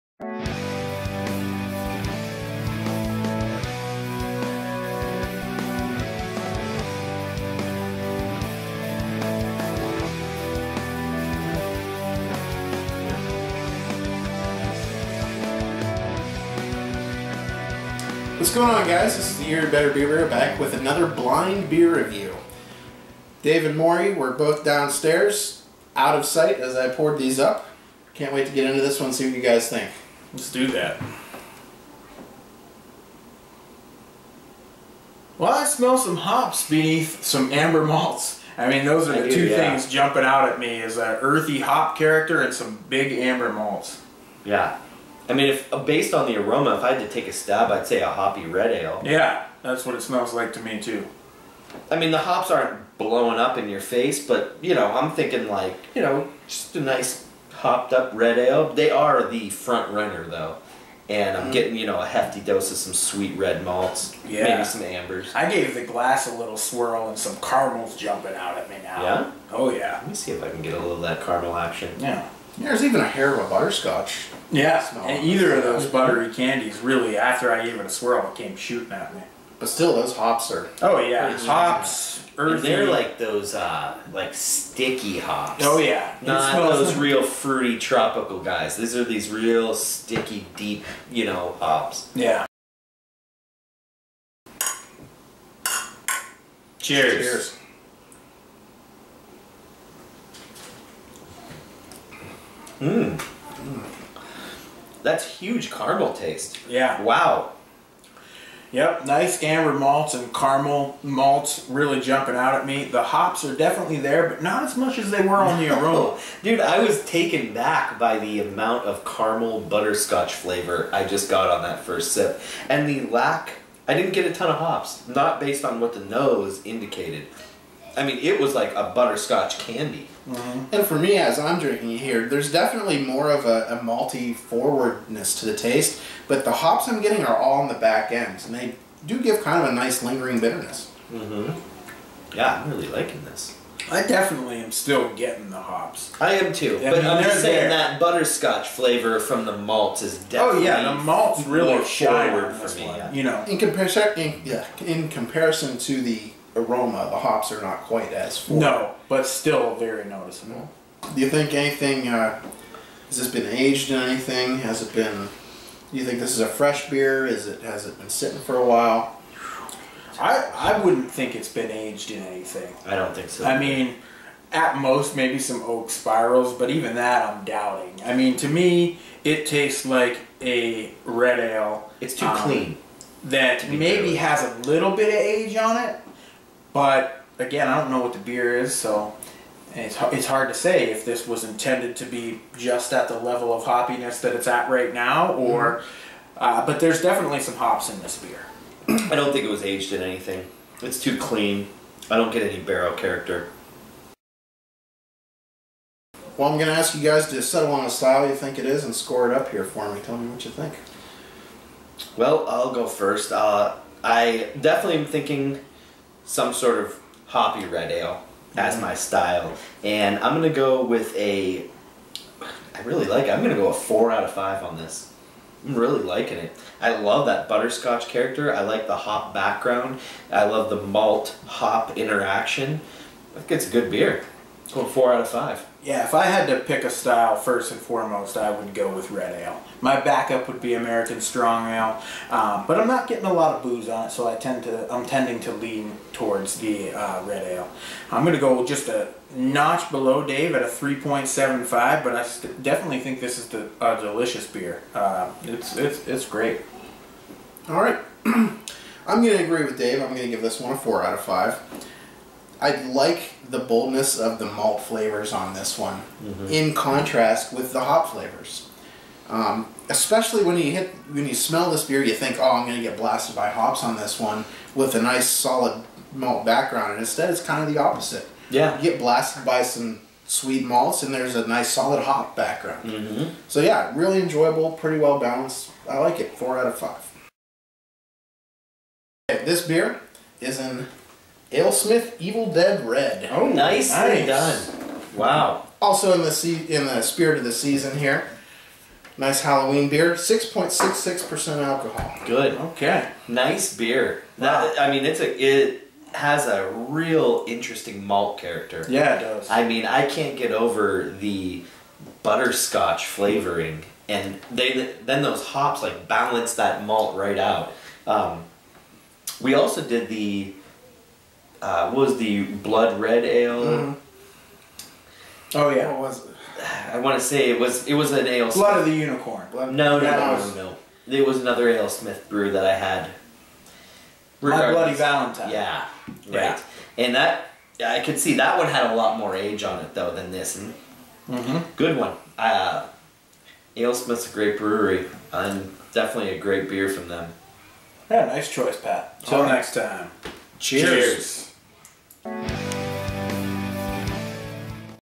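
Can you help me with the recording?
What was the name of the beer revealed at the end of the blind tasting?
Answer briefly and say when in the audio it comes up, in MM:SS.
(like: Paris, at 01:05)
Evil Dead Red, at 04:52.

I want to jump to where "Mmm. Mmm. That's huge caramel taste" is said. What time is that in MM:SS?
01:42.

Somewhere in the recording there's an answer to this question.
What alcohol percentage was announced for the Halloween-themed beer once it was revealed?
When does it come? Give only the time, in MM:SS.
05:00.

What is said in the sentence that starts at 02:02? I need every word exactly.
And the lack, I didn't get a ton of hops, not based on what the nose indicated.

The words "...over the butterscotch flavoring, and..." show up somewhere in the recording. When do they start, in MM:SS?
05:10.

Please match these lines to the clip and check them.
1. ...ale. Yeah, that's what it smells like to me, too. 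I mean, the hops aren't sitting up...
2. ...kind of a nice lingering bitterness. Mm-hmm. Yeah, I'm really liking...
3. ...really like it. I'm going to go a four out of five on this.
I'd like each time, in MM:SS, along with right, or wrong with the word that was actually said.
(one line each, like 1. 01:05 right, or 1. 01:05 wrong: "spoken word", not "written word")
1. 00:48 wrong: "blowing", not "sitting"
2. 02:19 right
3. 03:42 right.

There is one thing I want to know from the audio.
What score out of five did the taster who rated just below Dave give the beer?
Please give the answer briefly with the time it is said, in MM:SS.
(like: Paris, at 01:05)
3.75, at 04:10.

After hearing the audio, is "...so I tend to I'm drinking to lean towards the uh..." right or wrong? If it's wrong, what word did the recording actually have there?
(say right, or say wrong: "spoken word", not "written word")
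wrong: "tending", not "drinking".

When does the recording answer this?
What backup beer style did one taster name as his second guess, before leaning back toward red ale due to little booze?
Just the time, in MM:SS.
04:00.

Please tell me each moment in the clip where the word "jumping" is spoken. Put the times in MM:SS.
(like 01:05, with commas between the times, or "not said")
00:39, 01:07, 01:51.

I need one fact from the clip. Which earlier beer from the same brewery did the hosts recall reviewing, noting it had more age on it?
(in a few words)
My Bloody Valentine.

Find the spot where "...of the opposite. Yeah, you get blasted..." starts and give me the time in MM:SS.
04:37.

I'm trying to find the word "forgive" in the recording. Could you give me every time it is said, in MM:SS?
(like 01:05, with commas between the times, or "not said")
not said.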